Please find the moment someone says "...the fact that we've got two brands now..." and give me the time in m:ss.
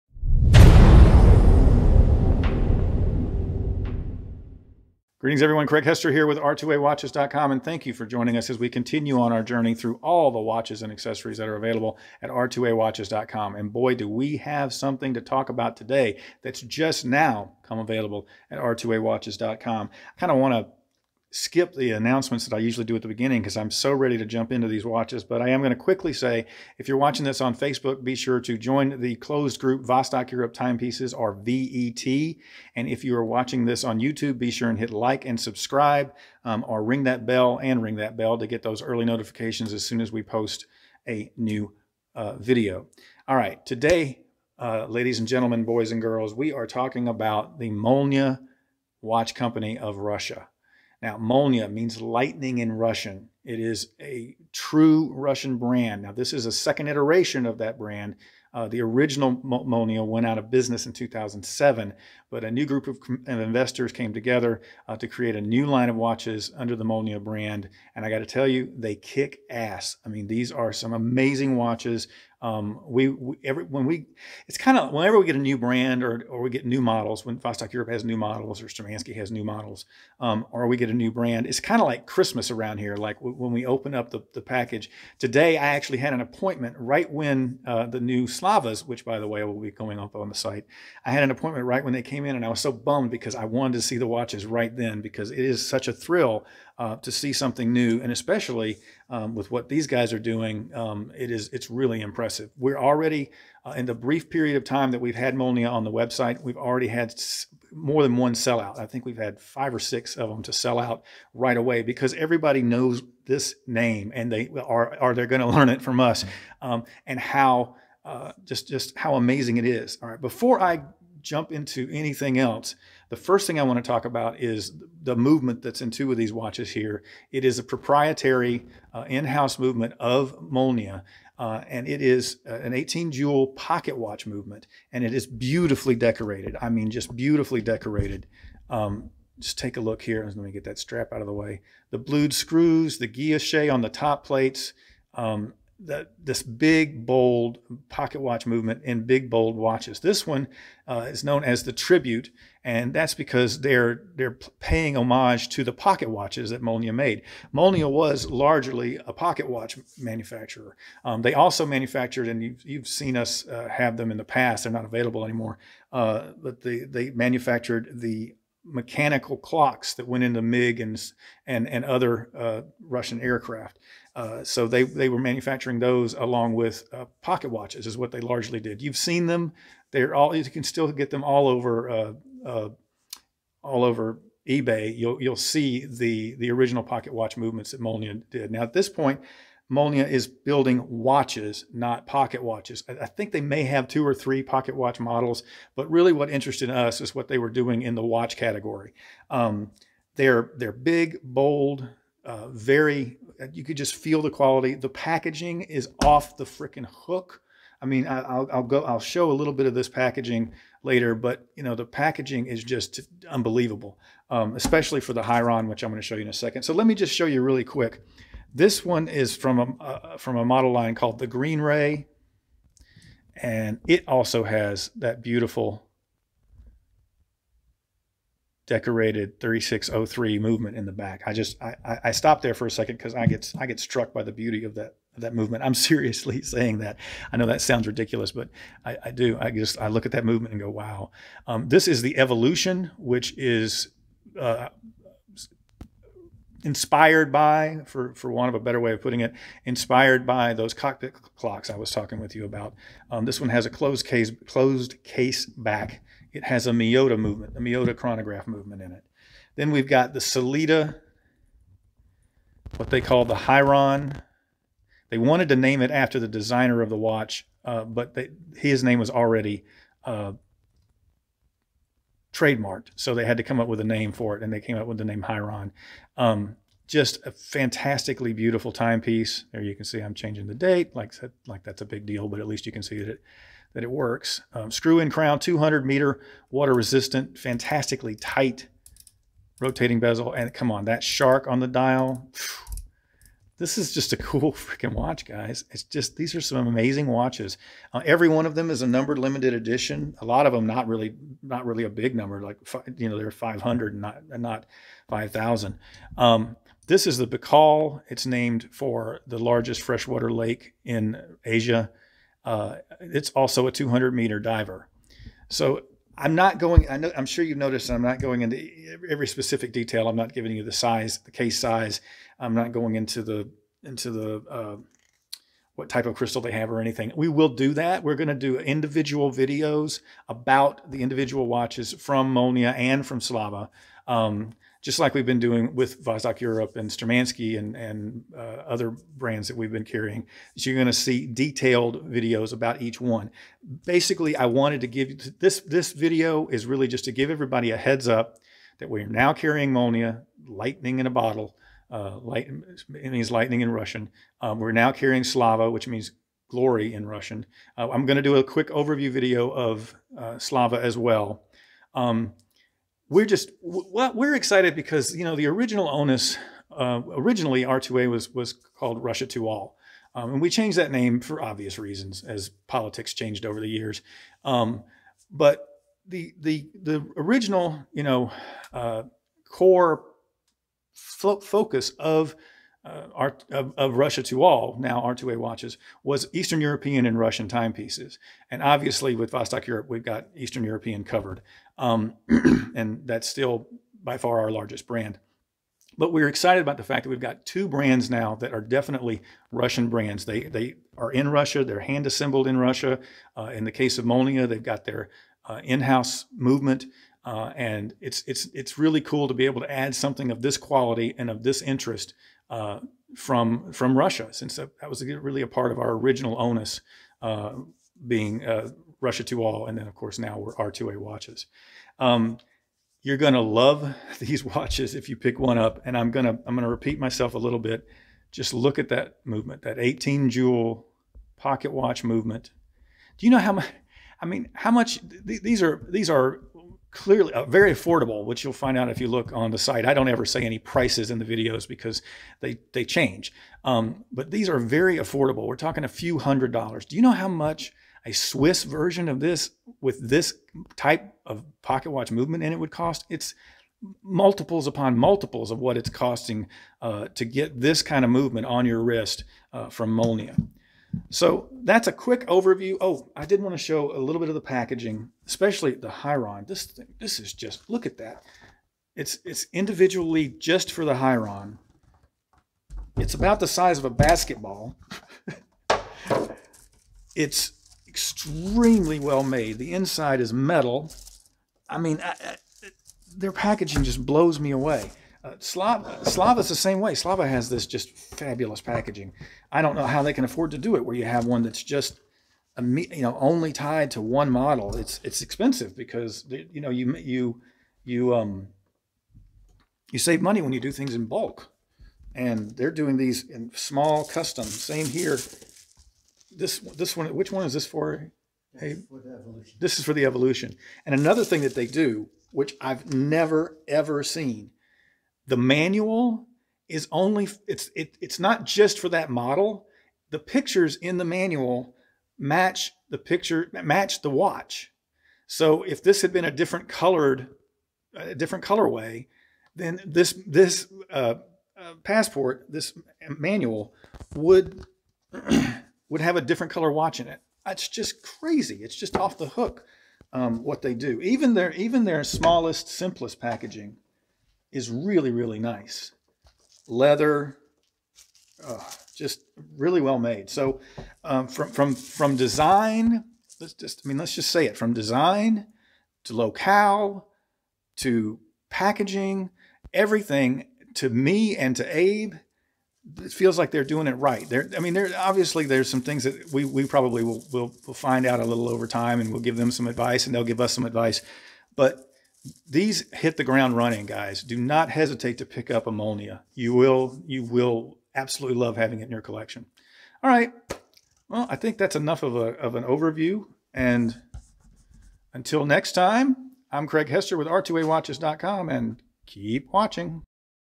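6:36.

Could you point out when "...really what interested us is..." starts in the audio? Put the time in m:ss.
3:15.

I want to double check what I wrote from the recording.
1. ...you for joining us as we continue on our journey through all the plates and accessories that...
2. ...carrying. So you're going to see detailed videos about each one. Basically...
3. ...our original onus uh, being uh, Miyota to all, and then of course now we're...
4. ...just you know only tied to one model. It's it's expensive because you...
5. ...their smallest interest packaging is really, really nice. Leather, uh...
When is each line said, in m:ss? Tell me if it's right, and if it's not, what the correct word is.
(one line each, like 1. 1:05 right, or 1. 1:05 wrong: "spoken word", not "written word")
1. 0:07 wrong: "watches", not "plates"
2. 5:39 right
3. 6:55 wrong: "Russia", not "Miyota"
4. 8:11 right
5. 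9:01 wrong: "simplest", not "interest".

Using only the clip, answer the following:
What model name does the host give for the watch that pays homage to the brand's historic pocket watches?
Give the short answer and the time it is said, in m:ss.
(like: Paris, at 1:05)
Tribute, at 2:31.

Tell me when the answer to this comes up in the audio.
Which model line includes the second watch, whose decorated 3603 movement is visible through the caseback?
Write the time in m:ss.
3:41.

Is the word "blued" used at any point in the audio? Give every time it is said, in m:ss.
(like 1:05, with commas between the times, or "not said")
2:21.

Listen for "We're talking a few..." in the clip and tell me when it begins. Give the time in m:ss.
7:25.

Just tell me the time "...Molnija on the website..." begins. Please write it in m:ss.
1:45.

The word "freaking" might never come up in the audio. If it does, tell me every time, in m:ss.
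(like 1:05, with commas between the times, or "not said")
3:26, 4:54.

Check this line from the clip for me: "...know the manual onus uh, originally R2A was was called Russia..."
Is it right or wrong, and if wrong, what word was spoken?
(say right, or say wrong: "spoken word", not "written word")
wrong: "original", not "manual".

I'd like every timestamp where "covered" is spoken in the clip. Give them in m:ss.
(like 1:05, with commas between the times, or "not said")
6:31.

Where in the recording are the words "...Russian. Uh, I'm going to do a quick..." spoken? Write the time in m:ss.
5:57.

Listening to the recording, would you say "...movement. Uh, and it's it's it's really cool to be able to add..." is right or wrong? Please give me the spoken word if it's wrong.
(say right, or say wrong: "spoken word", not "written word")
right.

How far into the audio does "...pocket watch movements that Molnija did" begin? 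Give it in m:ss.
3:06.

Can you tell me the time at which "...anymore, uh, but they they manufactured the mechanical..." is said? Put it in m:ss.
2:45.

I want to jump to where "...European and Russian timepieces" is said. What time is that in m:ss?
6:26.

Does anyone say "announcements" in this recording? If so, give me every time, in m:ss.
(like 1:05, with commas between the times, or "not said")
0:21.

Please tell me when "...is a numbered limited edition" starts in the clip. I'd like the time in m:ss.
4:58.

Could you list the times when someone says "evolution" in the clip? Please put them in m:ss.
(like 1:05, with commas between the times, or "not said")
4:02, 8:30.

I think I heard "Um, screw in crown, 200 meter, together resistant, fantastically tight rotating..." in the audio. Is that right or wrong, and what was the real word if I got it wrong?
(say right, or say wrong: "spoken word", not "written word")
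wrong: "water", not "together".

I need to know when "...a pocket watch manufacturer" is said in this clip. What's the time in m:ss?
2:39.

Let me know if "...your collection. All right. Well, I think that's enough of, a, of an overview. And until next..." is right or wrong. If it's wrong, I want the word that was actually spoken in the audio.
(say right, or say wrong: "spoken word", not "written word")
right.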